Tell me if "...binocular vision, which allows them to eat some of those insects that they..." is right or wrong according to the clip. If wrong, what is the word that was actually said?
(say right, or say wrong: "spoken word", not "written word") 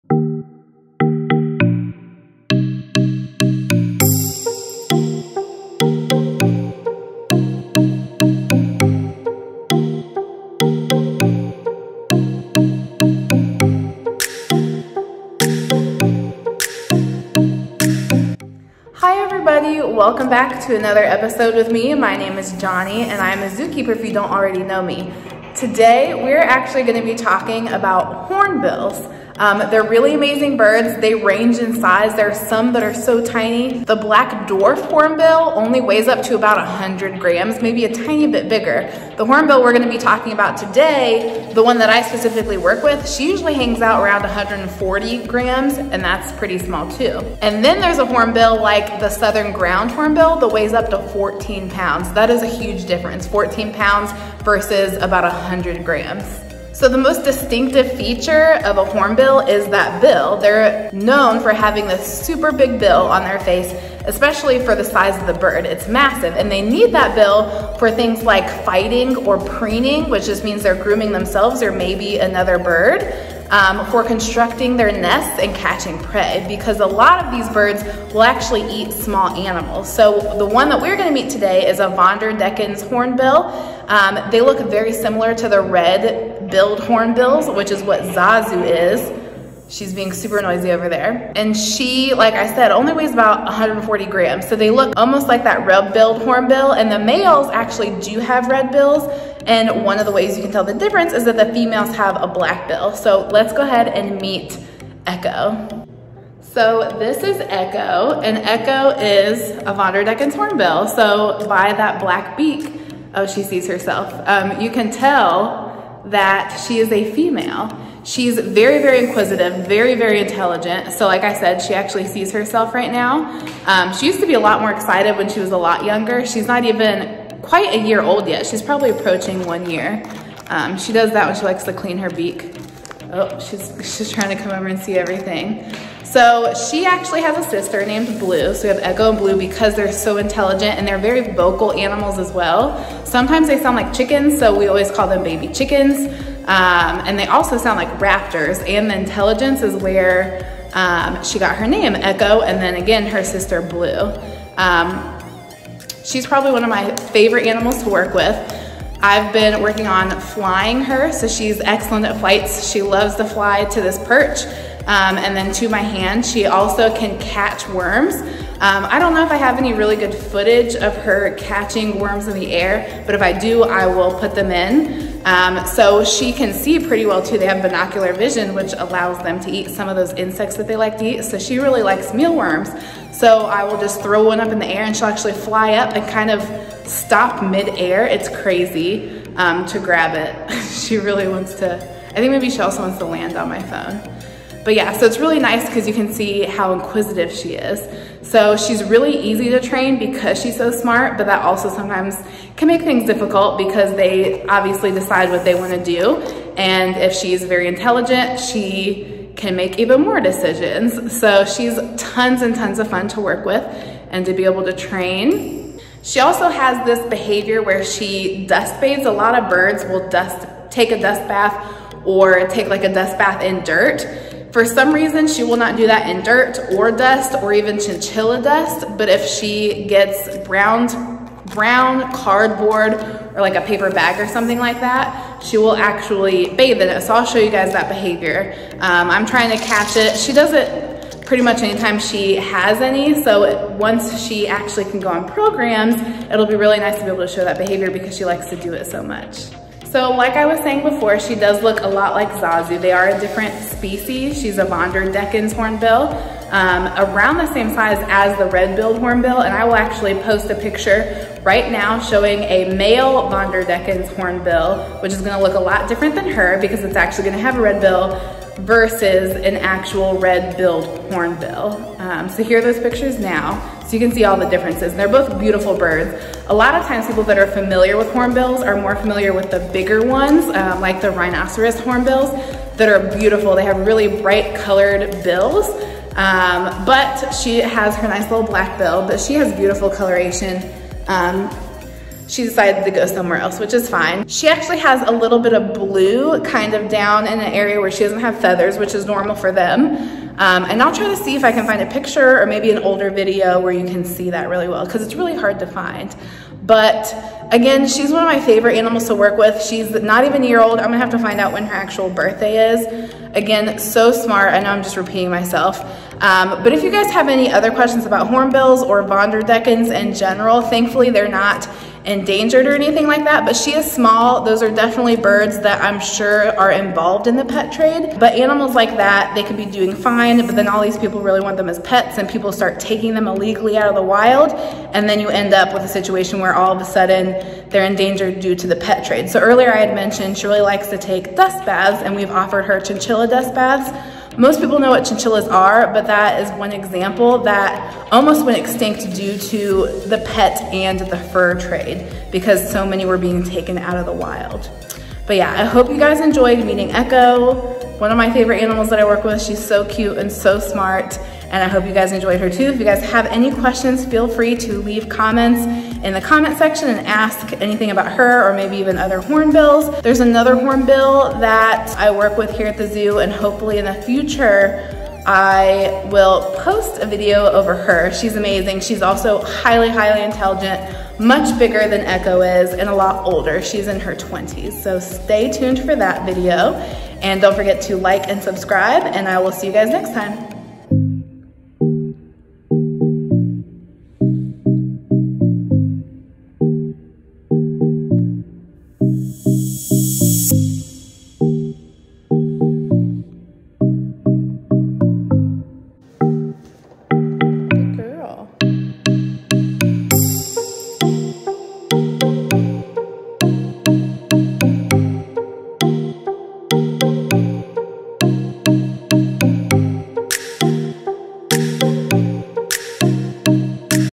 right.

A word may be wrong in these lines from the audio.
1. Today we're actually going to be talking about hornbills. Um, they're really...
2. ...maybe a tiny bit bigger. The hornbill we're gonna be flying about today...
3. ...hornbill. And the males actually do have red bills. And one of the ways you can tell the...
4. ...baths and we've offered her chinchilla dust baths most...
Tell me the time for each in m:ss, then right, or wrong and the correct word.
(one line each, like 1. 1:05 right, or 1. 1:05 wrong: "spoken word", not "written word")
1. 0:25 right
2. 0:37 wrong: "talking", not "flying"
3. 1:36 right
4. 5:41 right.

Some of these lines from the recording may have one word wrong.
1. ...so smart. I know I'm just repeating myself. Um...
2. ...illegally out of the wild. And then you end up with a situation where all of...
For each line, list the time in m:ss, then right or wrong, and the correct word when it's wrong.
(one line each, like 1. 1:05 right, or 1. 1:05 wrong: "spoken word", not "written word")
1. 5:13 right
2. 5:33 right.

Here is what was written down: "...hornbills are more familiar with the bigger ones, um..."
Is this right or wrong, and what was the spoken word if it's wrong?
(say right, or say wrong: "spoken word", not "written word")
right.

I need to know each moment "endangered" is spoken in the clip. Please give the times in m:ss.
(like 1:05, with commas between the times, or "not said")
5:22, 5:37.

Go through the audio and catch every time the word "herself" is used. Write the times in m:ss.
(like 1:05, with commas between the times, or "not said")
1:53, 2:02.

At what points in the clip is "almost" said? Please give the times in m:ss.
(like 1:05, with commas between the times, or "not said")
1:34, 5:48.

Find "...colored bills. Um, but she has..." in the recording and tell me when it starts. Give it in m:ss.
4:44.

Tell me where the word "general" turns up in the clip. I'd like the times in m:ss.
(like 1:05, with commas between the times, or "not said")
5:20.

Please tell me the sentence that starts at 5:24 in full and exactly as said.
Those are definitely birds that I'm sure are involved in the pet trade.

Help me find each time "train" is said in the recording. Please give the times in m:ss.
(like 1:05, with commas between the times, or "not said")
3:19, 3:34.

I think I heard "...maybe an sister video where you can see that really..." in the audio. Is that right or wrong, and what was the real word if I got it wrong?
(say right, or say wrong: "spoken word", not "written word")
wrong: "older", not "sister".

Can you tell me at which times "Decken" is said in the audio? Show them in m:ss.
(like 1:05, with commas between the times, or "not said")
1:22, 1:50, 5:19.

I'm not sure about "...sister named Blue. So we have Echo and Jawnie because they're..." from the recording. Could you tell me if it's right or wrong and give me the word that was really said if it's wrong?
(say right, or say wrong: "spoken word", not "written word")
wrong: "Blue", not "Jawnie".